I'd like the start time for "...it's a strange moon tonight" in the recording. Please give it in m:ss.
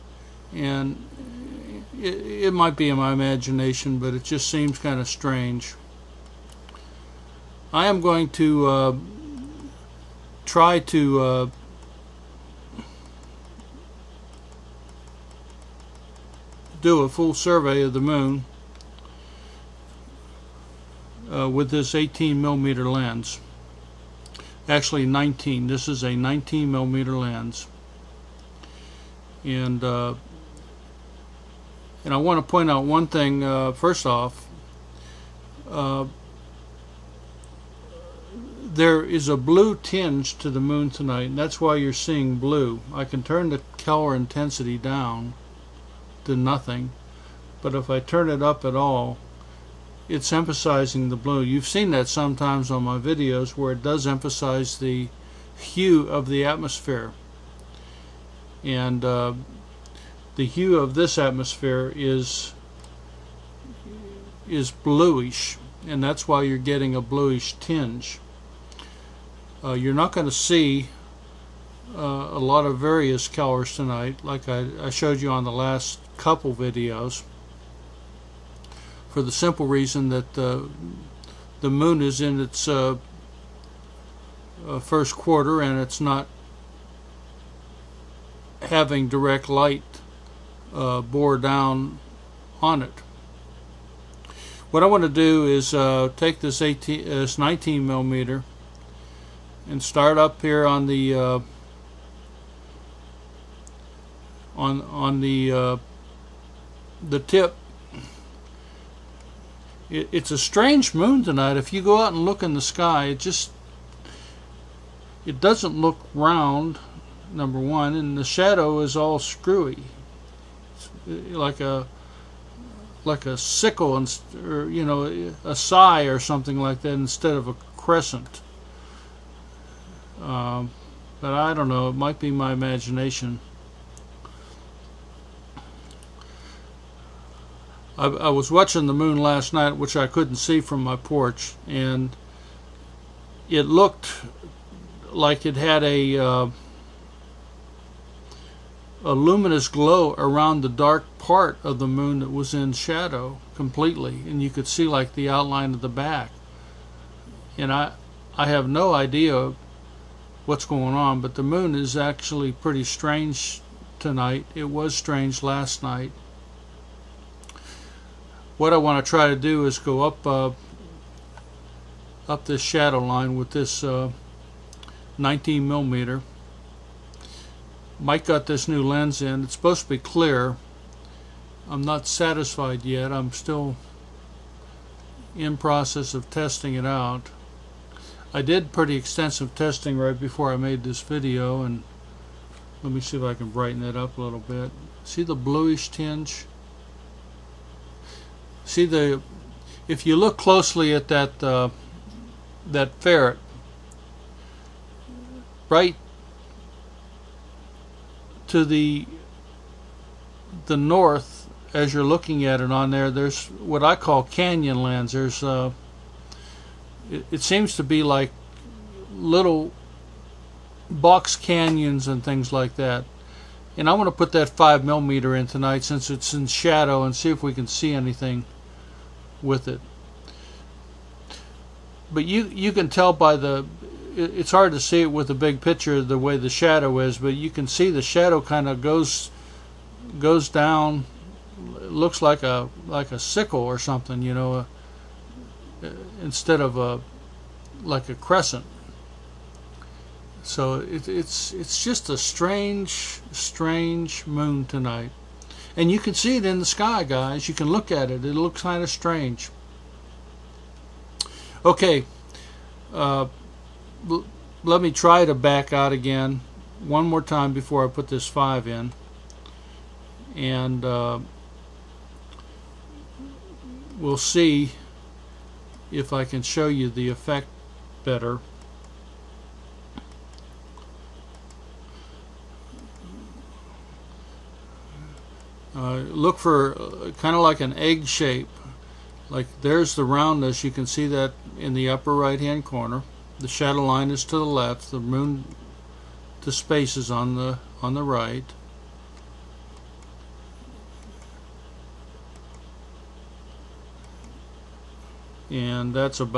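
1:50.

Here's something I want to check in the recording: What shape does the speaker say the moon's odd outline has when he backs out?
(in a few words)
Egg shape.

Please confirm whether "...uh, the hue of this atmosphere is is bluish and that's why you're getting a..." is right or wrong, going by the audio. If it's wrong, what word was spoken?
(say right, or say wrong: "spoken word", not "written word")
right.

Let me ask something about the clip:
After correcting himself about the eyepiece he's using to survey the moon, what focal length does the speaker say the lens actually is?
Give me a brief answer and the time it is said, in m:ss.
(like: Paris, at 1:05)
19 millimeter, at 0:26.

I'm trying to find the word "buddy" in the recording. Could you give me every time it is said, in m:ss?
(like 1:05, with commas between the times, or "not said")
not said.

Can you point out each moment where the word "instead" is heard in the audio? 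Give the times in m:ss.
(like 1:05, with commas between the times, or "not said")
2:06, 4:06.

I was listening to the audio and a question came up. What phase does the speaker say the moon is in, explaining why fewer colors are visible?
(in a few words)
First quarter.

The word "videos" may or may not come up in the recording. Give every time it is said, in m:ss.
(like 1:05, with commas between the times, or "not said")
0:52, 1:16, 3:11.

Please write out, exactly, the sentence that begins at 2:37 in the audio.
And I I have no idea what's going on, but the moon is actually pretty strange tonight.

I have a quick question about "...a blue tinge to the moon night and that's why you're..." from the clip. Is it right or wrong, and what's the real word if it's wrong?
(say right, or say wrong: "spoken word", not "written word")
wrong: "tonight", not "night".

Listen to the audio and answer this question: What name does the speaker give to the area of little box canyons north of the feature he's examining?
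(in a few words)
Canyon lands.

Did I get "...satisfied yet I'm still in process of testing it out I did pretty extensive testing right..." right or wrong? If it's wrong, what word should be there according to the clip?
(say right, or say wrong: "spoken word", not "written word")
right.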